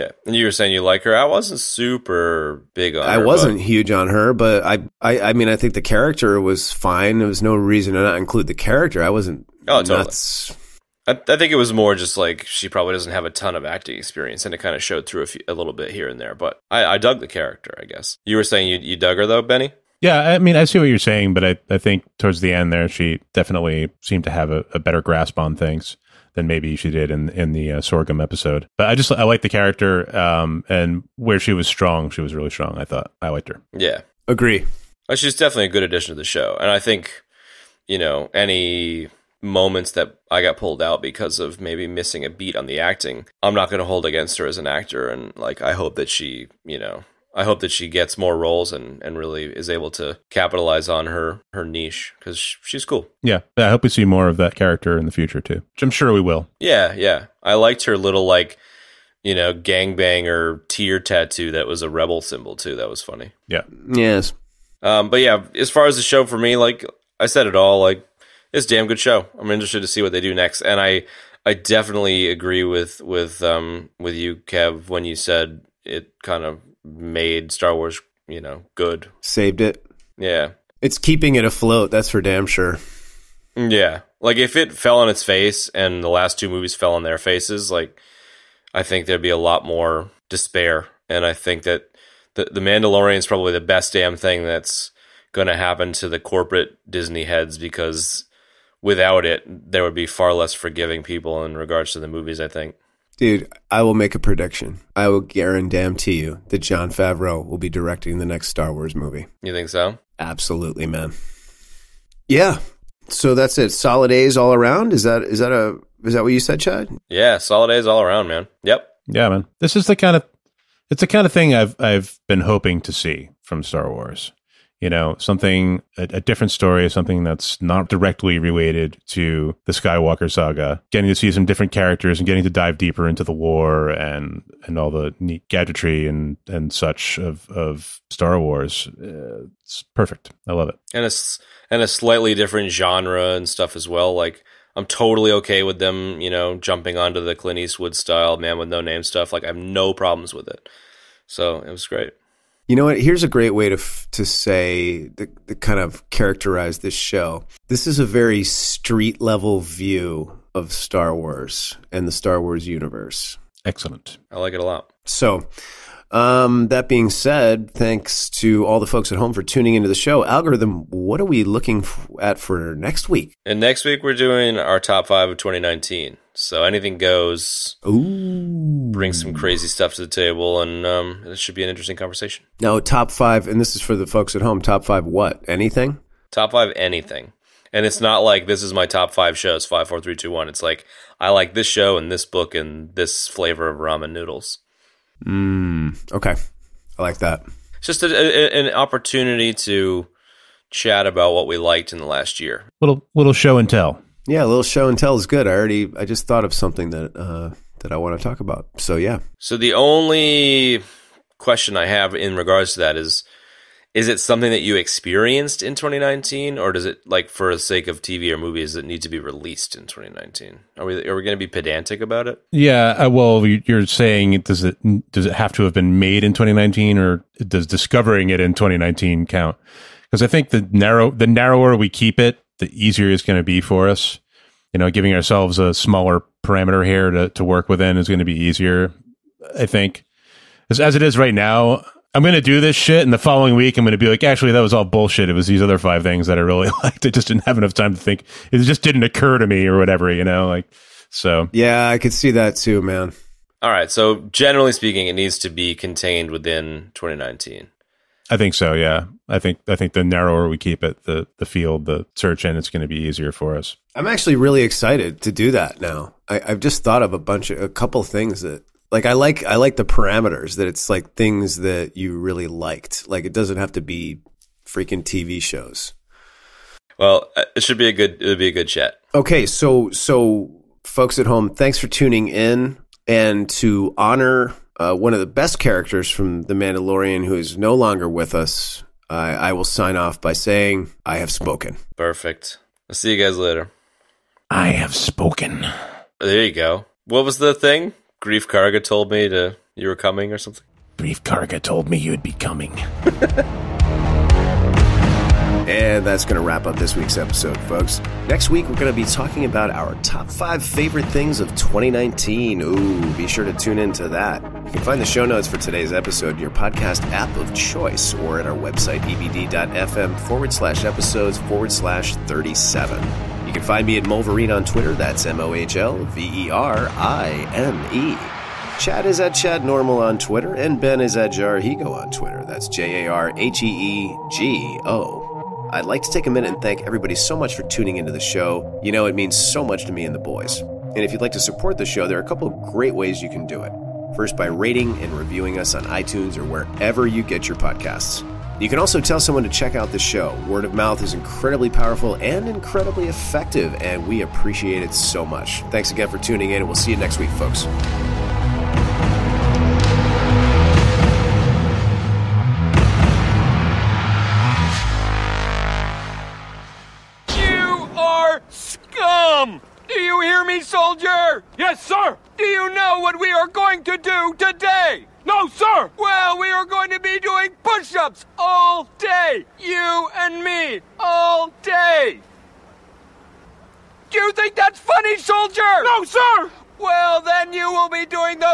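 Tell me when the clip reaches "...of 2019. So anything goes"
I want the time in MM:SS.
02:55.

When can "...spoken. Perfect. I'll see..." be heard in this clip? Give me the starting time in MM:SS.
04:51.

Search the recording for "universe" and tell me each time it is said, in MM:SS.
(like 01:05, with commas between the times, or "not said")
02:42.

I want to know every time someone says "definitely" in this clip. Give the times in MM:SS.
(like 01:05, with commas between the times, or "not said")
00:23, 00:35, 01:11.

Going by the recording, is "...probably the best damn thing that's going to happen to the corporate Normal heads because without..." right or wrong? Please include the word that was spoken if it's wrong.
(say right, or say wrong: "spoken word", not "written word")
wrong: "Disney", not "Normal".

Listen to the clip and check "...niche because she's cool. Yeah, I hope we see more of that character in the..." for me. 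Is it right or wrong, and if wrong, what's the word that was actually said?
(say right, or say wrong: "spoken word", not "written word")
right.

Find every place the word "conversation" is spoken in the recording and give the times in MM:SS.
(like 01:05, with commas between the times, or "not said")
03:01.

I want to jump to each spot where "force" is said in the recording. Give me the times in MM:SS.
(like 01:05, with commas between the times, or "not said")
not said.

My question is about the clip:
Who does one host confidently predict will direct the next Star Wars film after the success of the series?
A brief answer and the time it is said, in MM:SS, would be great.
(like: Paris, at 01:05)
Jon Favreau, at 01:46.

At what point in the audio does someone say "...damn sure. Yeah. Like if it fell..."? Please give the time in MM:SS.
01:22.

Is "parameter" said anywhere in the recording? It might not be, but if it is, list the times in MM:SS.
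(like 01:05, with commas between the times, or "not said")
03:56, 04:29.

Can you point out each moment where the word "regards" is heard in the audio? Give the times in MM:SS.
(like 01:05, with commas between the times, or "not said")
01:41, 03:32.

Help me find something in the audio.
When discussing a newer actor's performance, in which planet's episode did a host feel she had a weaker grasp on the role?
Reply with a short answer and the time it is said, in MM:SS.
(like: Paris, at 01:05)
Sorgan, at 00:27.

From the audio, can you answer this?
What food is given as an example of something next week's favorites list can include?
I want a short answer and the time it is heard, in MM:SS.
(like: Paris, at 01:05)
ramen noodles, at 03:13.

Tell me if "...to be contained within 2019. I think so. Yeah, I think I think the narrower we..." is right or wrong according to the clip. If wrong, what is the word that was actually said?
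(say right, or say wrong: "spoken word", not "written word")
right.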